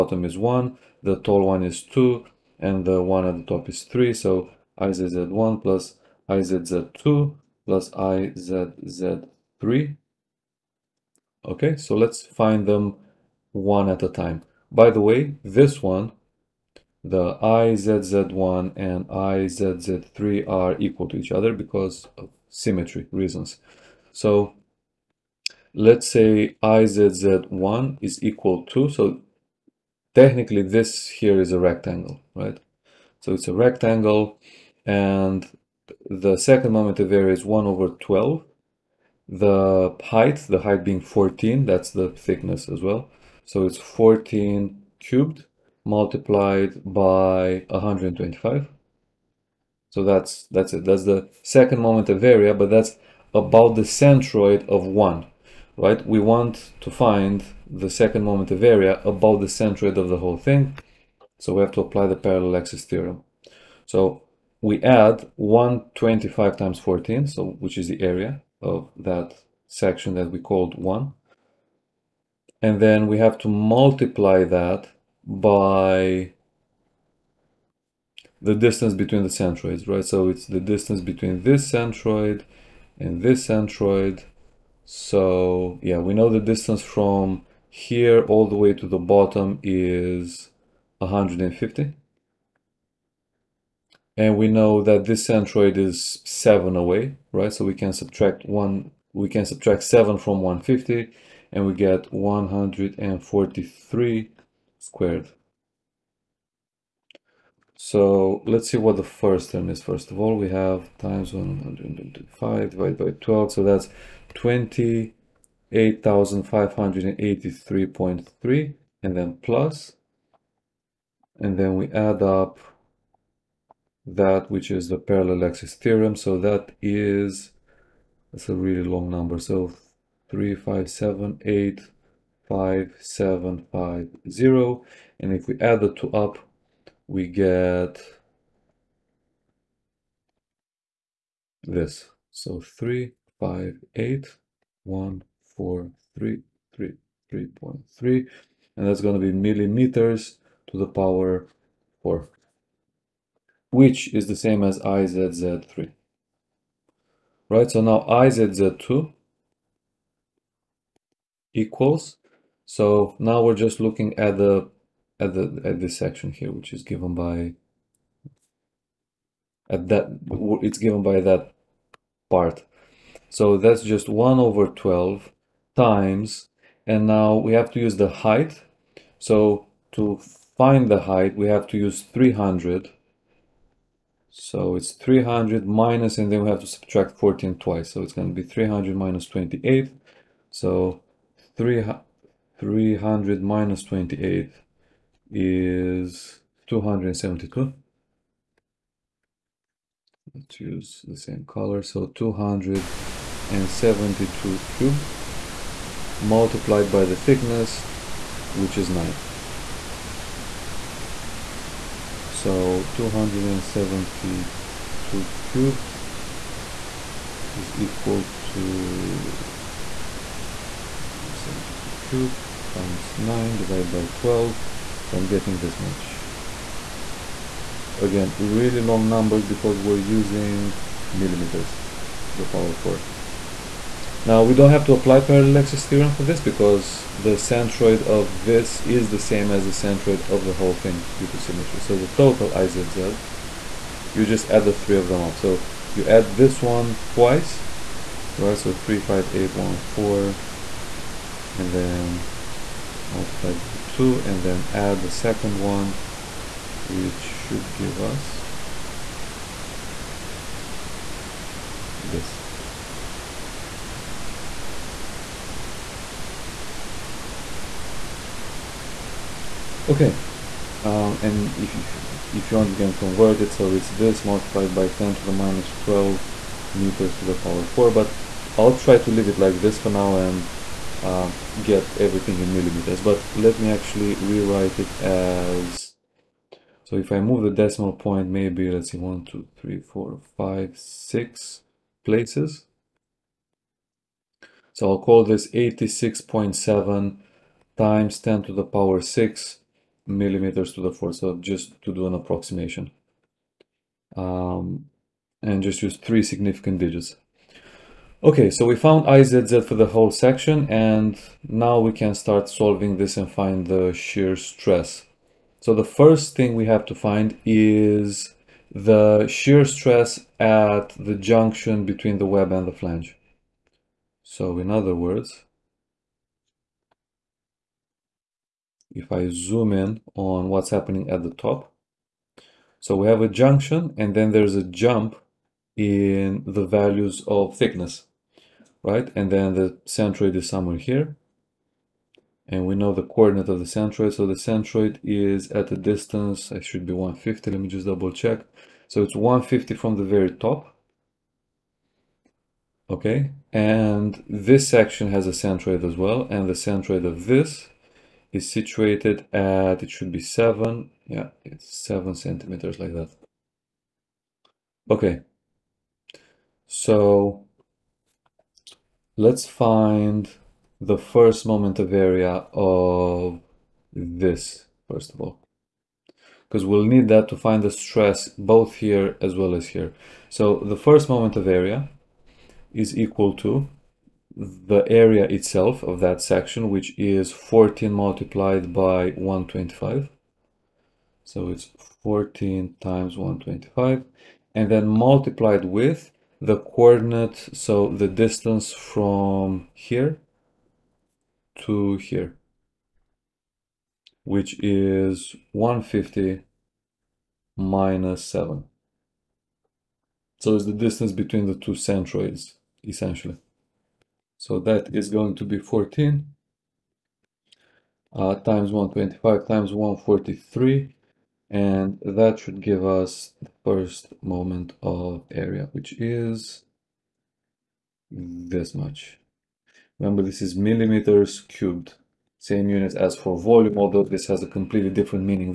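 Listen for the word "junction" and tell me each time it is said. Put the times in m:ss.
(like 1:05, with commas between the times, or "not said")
5:21, 5:33.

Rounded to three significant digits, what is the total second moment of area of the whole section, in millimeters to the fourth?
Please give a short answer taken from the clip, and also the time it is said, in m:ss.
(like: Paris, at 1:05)
86.7 × 10^6, at 4:55.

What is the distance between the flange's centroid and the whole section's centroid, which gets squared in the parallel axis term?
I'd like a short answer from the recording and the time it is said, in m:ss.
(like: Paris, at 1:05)
143, at 1:42.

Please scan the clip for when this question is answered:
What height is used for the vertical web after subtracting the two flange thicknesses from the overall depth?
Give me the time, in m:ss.
3:41.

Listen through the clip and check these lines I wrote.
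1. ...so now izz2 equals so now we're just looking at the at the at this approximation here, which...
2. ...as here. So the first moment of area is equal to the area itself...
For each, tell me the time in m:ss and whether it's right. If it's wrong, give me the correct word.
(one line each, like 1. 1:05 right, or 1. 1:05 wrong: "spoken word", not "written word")
1. 2:37 wrong: "section", not "approximation"
2. 6:19 right.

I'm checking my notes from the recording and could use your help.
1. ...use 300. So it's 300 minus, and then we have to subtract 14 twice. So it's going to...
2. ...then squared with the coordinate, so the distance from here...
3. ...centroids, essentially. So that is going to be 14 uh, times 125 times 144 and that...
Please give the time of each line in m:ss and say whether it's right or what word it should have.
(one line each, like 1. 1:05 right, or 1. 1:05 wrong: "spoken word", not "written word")
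1. 3:01 right
2. 6:34 wrong: "multiplied", not "squared"
3. 6:51 wrong: "143", not "144".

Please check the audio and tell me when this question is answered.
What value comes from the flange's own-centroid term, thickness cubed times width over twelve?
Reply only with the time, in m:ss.
1:54.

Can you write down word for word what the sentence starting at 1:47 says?
So let's see what the first term is.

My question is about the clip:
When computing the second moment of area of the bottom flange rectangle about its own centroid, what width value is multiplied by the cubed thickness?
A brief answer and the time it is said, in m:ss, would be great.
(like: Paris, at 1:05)
125, at 0:43.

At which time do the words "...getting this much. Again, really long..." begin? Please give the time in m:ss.
3:45.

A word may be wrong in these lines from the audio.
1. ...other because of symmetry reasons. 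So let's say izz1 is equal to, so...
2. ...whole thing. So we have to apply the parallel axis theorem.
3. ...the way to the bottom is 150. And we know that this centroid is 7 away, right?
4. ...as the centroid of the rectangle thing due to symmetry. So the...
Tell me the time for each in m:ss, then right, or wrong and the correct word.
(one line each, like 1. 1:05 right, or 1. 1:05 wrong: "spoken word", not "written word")
1. 0:21 right
2. 1:00 right
3. 1:28 right
4. 3:59 wrong: "whole", not "rectangle".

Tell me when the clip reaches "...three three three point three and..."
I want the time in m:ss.
2:26.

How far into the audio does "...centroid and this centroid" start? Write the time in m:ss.
1:21.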